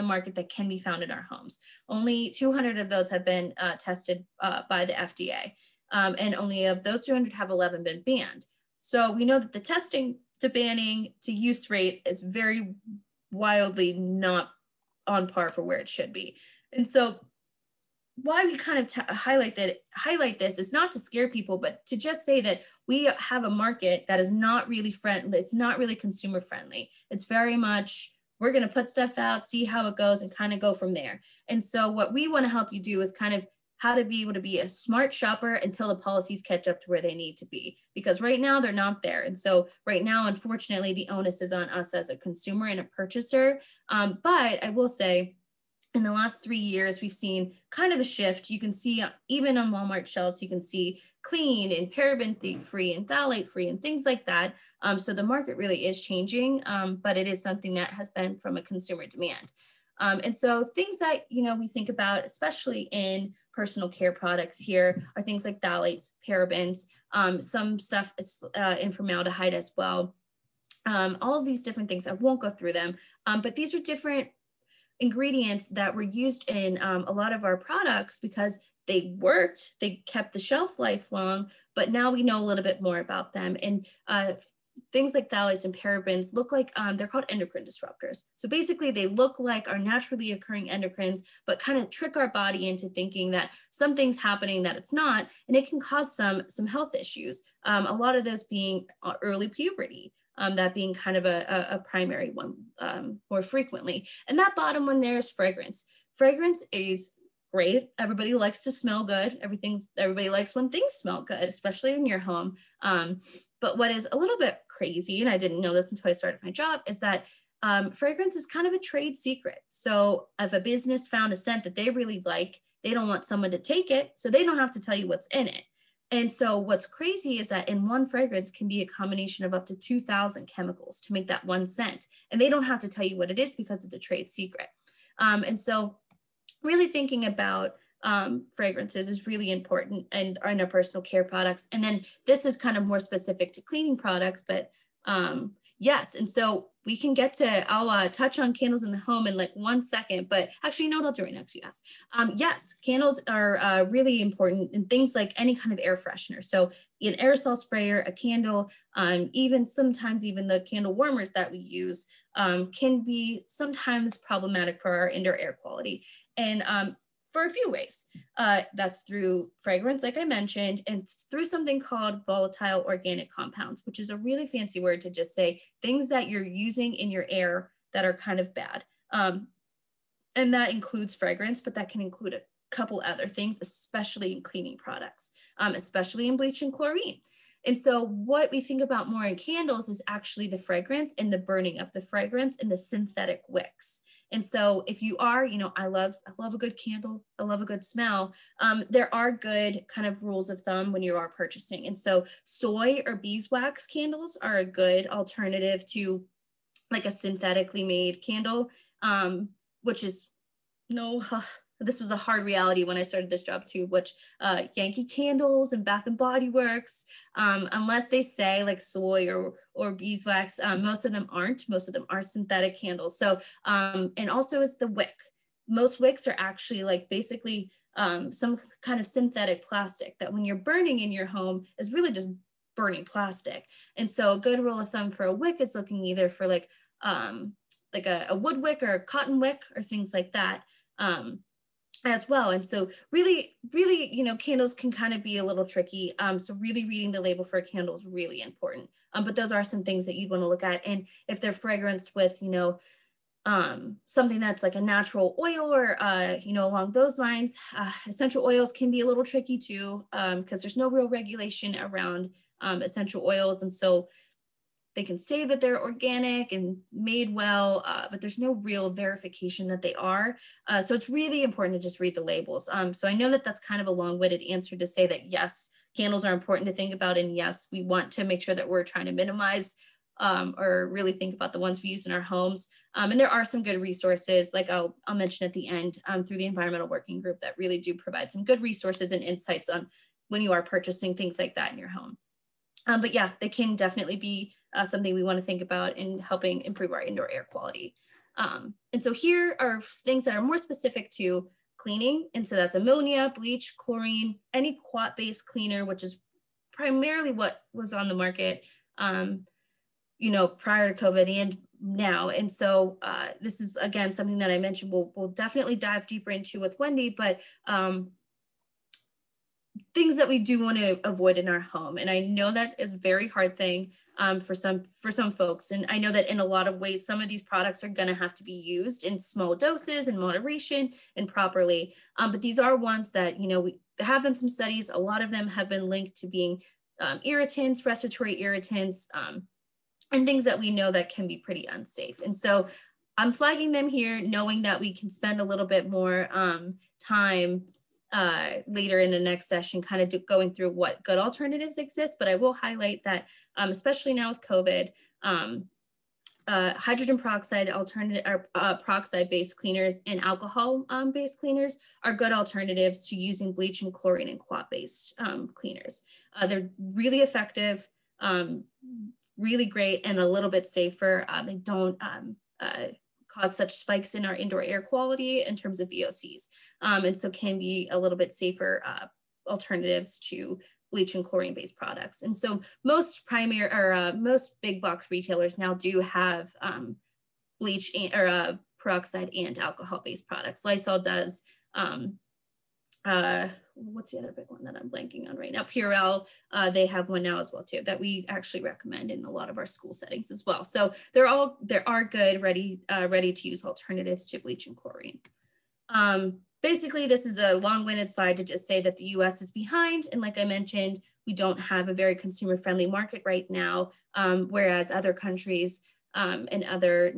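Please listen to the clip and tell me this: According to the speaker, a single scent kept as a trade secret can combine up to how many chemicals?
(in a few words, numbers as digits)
2,000.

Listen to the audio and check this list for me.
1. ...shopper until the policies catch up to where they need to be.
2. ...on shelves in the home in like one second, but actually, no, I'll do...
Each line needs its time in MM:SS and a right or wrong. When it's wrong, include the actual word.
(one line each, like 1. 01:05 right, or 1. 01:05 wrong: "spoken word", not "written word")
1. 00:35 right
2. 02:28 wrong: "candles", not "shelves".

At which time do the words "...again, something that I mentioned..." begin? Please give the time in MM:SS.
05:13.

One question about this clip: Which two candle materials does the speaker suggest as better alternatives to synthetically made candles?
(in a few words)
soy or beeswax.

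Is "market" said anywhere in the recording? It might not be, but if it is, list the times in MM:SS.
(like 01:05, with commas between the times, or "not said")
00:00, 00:23, 00:55, 05:08, 06:52.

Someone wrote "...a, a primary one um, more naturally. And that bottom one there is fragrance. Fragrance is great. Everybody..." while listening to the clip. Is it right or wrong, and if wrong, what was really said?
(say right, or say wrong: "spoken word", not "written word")
wrong: "frequently", not "naturally".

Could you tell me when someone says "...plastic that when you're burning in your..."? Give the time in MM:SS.
03:49.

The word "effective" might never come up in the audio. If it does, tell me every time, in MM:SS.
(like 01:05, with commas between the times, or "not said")
06:07.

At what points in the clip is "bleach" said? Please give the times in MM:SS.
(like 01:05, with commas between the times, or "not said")
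03:06, 05:03, 06:03, 06:20, 06:27, 06:44.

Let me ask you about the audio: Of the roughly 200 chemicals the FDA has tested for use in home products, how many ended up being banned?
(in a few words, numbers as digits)
11.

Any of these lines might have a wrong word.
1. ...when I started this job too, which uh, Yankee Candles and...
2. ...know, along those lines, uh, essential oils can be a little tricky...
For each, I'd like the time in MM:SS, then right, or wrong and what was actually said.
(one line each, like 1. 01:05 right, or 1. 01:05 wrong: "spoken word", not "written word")
1. 03:32 right
2. 04:16 right.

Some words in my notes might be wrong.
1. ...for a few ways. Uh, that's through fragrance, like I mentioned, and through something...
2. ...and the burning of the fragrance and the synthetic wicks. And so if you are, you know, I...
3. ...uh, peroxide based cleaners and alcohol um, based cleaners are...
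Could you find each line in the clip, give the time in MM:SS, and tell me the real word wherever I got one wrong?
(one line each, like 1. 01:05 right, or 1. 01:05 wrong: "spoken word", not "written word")
1. 02:47 right
2. 03:11 right
3. 05:58 right.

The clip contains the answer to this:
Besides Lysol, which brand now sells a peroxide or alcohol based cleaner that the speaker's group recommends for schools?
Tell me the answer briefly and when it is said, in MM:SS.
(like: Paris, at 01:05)
Purell, at 06:35.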